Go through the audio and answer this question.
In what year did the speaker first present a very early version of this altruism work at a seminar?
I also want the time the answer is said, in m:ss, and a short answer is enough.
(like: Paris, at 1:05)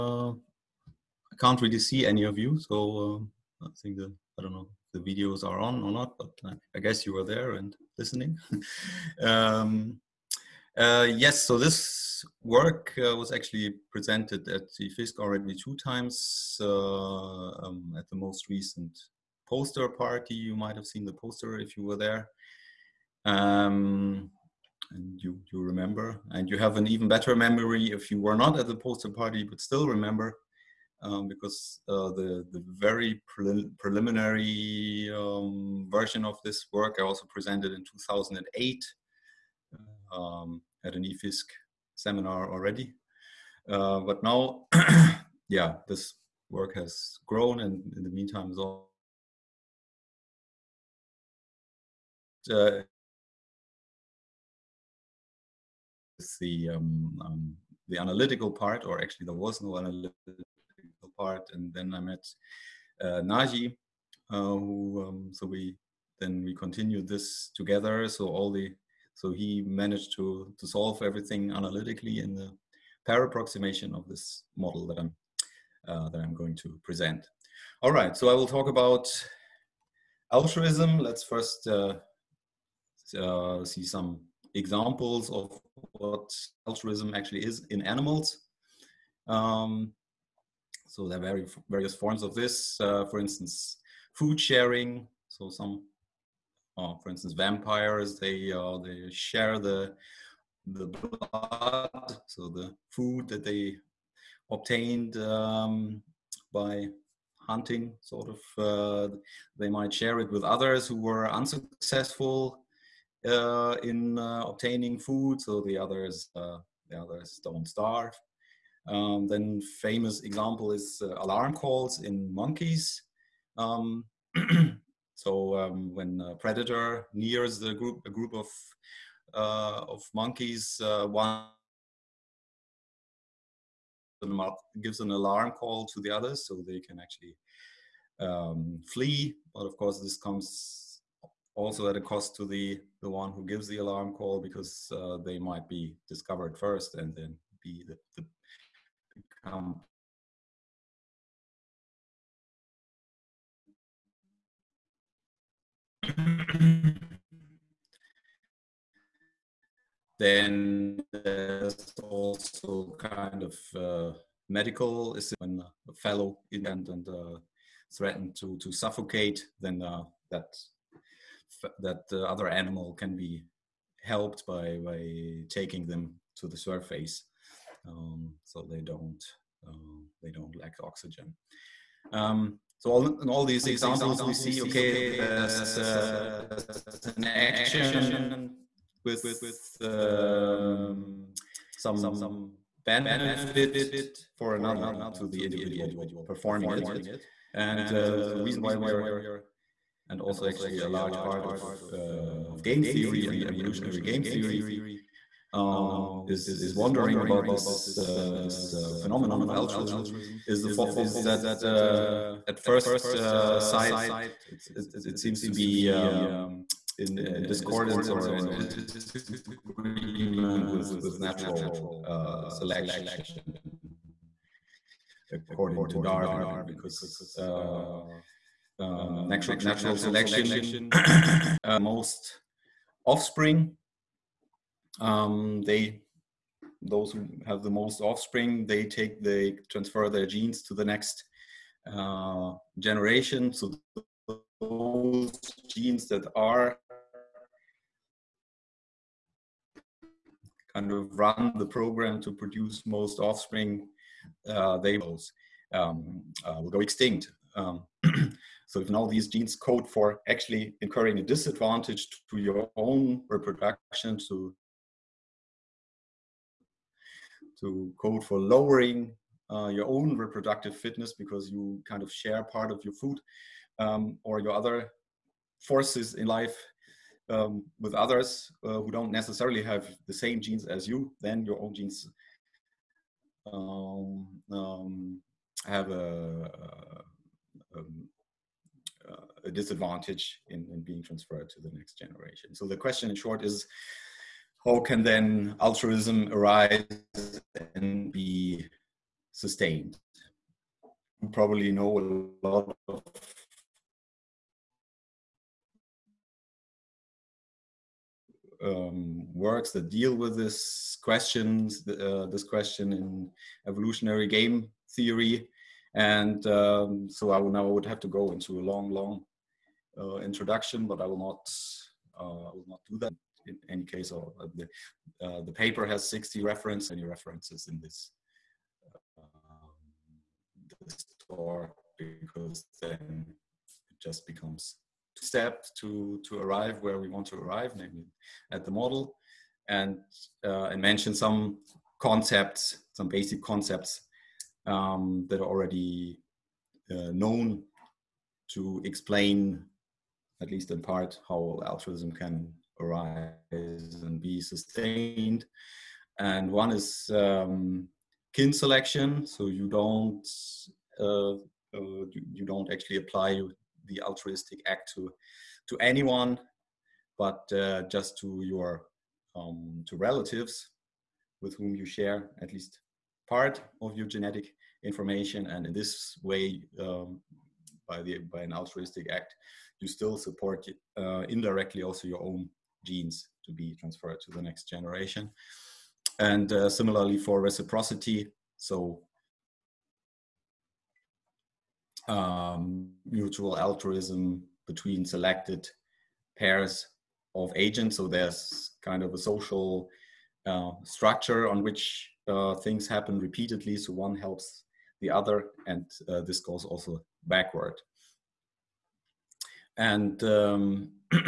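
2008, at 0:37.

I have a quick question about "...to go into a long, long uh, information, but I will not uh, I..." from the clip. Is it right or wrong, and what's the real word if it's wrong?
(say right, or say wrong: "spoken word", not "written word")
wrong: "introduction", not "information".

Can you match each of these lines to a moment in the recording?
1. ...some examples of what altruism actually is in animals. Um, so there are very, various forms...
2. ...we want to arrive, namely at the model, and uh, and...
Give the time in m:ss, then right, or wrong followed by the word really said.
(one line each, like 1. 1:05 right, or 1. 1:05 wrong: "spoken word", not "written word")
1. 1:23 right
2. 5:36 right.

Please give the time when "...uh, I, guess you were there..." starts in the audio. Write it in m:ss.
0:06.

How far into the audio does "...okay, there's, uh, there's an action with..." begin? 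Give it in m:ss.
3:04.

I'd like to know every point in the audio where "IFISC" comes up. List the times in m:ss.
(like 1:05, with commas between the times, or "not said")
0:14.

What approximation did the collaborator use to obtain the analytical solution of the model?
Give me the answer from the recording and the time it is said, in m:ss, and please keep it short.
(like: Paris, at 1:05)
pair approximation, at 1:13.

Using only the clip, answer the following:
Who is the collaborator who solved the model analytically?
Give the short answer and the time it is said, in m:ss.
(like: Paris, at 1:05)
Nagi, at 1:03.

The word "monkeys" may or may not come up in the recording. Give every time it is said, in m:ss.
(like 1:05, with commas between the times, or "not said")
2:02, 2:10.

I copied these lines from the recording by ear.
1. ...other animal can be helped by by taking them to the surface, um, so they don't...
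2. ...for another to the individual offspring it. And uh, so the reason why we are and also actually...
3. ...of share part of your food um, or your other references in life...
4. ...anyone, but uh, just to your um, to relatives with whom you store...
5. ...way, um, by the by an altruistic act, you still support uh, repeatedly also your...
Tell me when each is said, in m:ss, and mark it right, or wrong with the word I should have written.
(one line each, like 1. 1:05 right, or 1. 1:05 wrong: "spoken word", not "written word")
1. 2:52 right
2. 3:14 wrong: "performing", not "offspring"
3. 4:32 wrong: "forces", not "references"
4. 6:05 wrong: "share", not "store"
5. 6:16 wrong: "indirectly", not "repeatedly".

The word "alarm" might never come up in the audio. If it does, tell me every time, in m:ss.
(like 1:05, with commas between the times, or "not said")
2:01, 2:15, 2:23.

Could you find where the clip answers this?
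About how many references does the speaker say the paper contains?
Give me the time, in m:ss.
5:26.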